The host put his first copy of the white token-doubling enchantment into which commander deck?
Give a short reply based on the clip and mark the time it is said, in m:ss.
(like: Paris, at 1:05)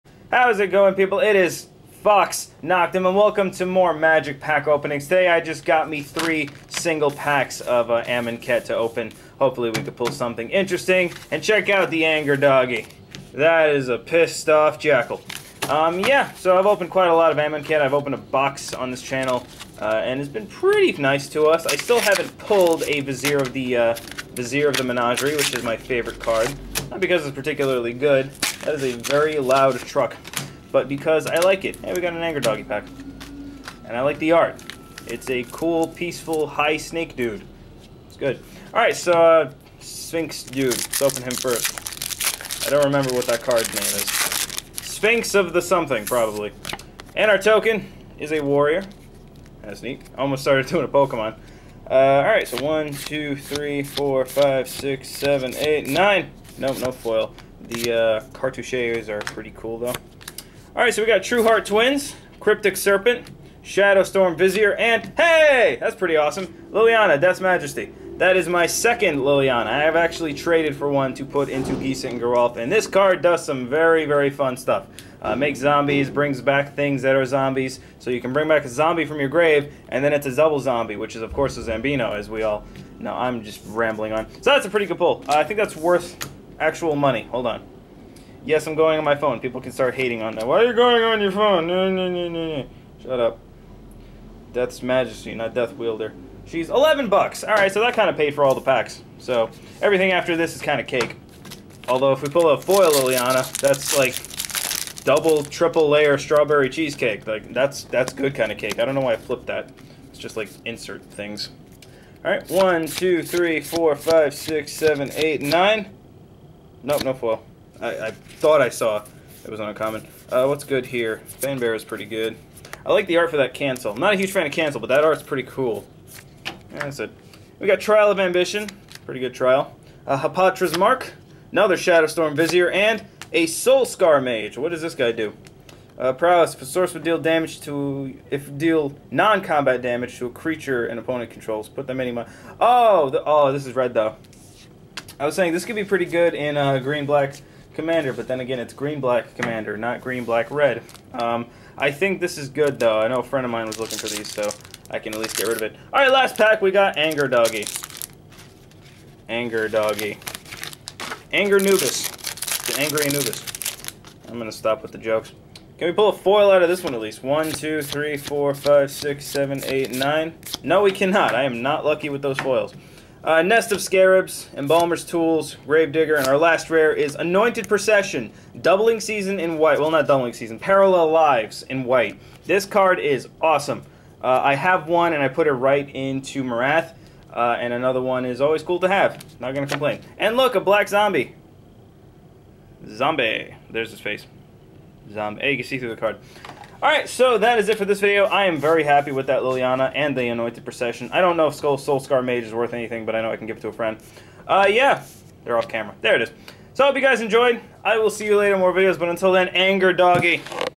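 Marath, at 3:06.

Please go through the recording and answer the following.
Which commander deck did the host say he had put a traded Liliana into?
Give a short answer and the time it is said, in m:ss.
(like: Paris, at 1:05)
Gisa and Geralf, at 1:11.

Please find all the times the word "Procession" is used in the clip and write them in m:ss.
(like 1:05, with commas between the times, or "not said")
2:57, 3:20.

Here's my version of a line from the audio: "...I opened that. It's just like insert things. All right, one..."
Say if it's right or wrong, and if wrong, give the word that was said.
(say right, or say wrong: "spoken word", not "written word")
wrong: "flipped", not "opened".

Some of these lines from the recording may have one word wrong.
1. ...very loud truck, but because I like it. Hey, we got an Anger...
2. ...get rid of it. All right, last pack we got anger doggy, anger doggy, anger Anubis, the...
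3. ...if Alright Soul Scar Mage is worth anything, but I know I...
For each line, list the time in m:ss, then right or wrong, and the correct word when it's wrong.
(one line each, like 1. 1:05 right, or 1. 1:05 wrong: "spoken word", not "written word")
1. 0:28 right
2. 2:35 right
3. 3:21 wrong: "Skull", not "Alright".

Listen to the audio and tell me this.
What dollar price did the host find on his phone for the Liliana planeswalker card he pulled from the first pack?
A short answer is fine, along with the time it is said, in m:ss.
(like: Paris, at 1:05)
$11, at 1:36.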